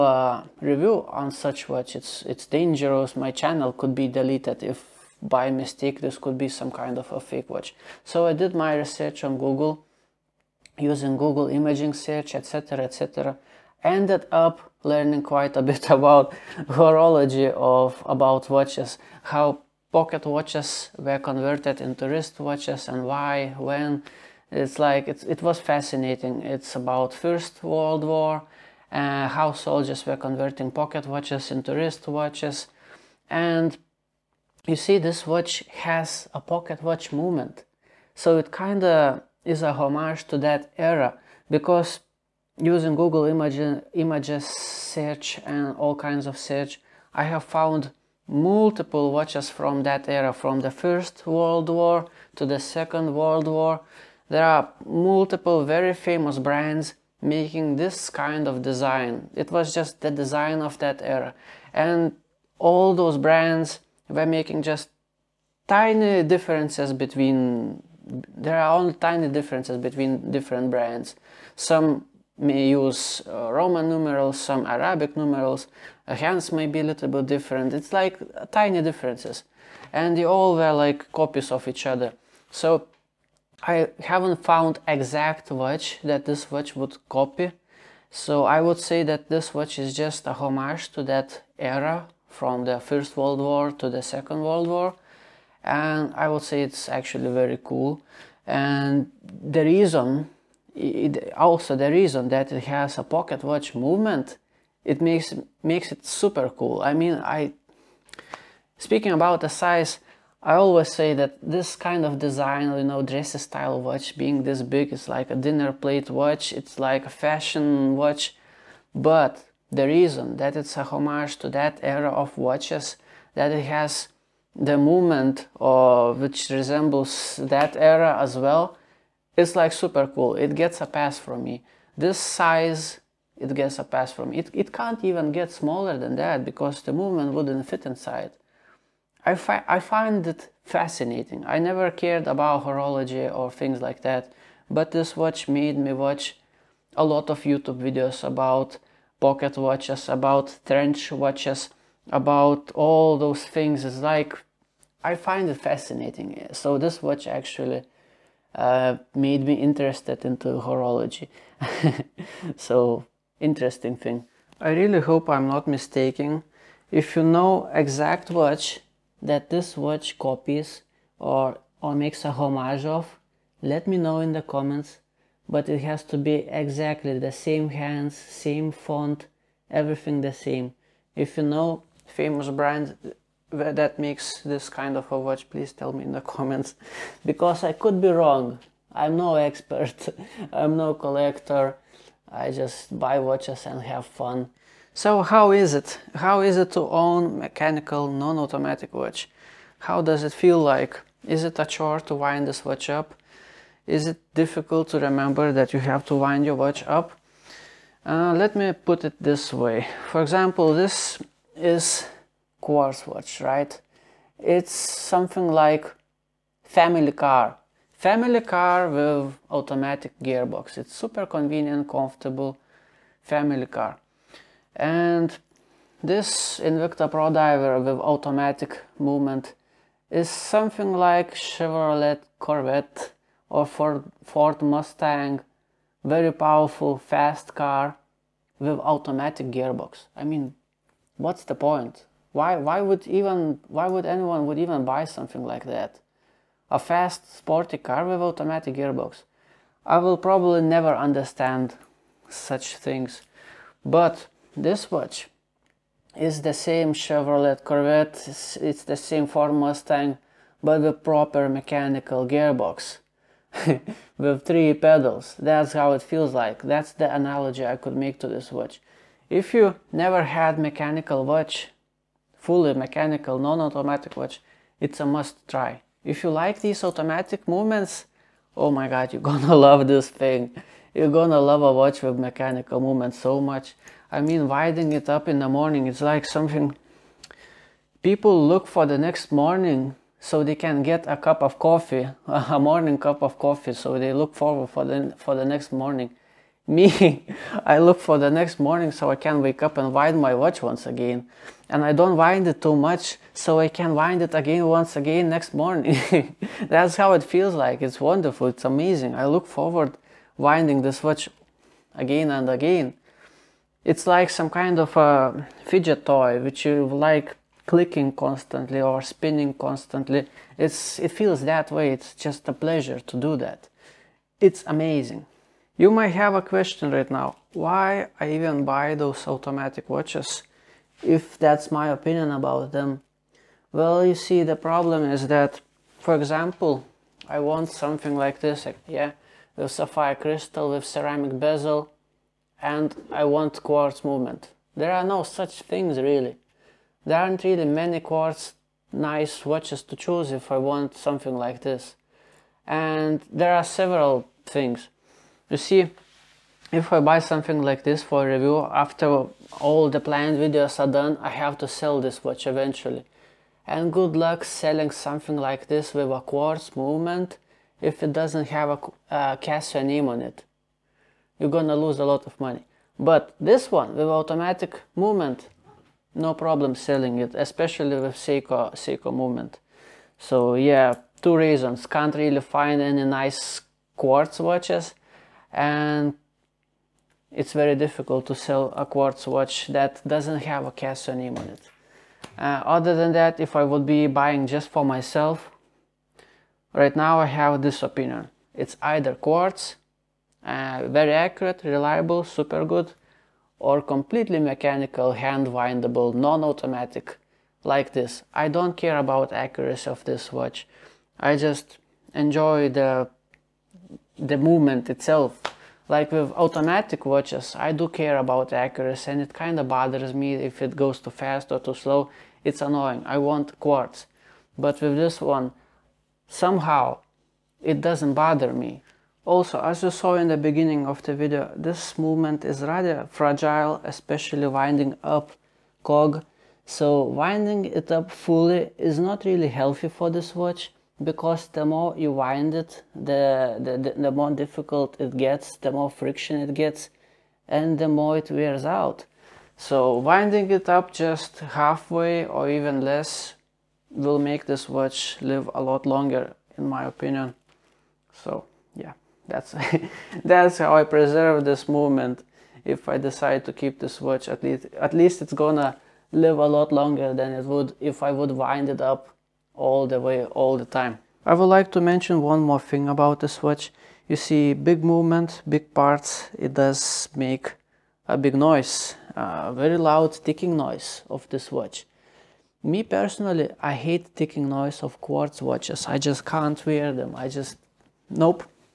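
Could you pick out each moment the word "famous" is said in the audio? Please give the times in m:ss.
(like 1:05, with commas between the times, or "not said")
0:55, 3:02.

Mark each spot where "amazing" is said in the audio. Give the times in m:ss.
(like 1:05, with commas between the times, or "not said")
5:08, 5:24.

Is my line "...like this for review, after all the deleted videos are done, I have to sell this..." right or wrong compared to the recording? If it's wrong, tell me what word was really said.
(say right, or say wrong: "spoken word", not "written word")
wrong: "planned", not "deleted".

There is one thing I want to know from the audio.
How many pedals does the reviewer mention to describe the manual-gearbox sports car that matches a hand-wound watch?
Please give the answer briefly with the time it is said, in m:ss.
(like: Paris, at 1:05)
3, at 4:24.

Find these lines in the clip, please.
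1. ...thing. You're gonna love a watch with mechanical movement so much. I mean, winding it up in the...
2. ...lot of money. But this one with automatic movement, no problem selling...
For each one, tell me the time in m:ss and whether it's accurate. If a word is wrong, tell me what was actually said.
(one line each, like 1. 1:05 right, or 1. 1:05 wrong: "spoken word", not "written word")
1. 4:40 right
2. 6:12 right.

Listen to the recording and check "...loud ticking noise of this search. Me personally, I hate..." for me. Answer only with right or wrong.
wrong.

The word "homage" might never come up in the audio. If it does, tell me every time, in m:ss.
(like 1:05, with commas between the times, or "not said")
0:39, 1:30, 2:00, 2:52.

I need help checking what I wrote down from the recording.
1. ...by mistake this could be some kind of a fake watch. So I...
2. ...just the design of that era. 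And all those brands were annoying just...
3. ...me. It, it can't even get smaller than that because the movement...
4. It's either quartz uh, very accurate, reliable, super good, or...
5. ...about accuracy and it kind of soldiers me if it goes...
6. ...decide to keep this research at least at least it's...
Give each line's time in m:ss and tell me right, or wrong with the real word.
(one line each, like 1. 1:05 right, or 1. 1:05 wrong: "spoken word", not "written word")
1. 0:05 right
2. 0:59 wrong: "making", not "annoying"
3. 2:14 right
4. 6:38 right
5. 6:58 wrong: "bothers", not "soldiers"
6. 7:42 wrong: "watch", not "research".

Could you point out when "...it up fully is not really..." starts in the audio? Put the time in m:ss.
7:17.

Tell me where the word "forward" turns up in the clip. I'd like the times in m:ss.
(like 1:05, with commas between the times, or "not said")
4:54, 5:09.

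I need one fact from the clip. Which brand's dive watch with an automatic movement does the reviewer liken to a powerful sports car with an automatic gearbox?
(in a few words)
Invicta.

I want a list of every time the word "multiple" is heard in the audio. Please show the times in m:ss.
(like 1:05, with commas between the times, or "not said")
0:48, 0:54.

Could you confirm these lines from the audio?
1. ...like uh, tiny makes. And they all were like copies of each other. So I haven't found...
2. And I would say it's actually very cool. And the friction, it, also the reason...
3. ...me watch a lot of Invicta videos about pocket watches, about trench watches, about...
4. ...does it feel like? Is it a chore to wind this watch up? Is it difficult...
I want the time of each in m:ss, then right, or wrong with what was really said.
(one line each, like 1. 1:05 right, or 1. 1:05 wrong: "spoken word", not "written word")
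1. 1:17 wrong: "differences", not "makes"
2. 1:35 wrong: "reason", not "friction"
3. 2:25 wrong: "YouTube", not "Invicta"
4. 3:20 right.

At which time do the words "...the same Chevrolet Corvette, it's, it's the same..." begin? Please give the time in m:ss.
4:16.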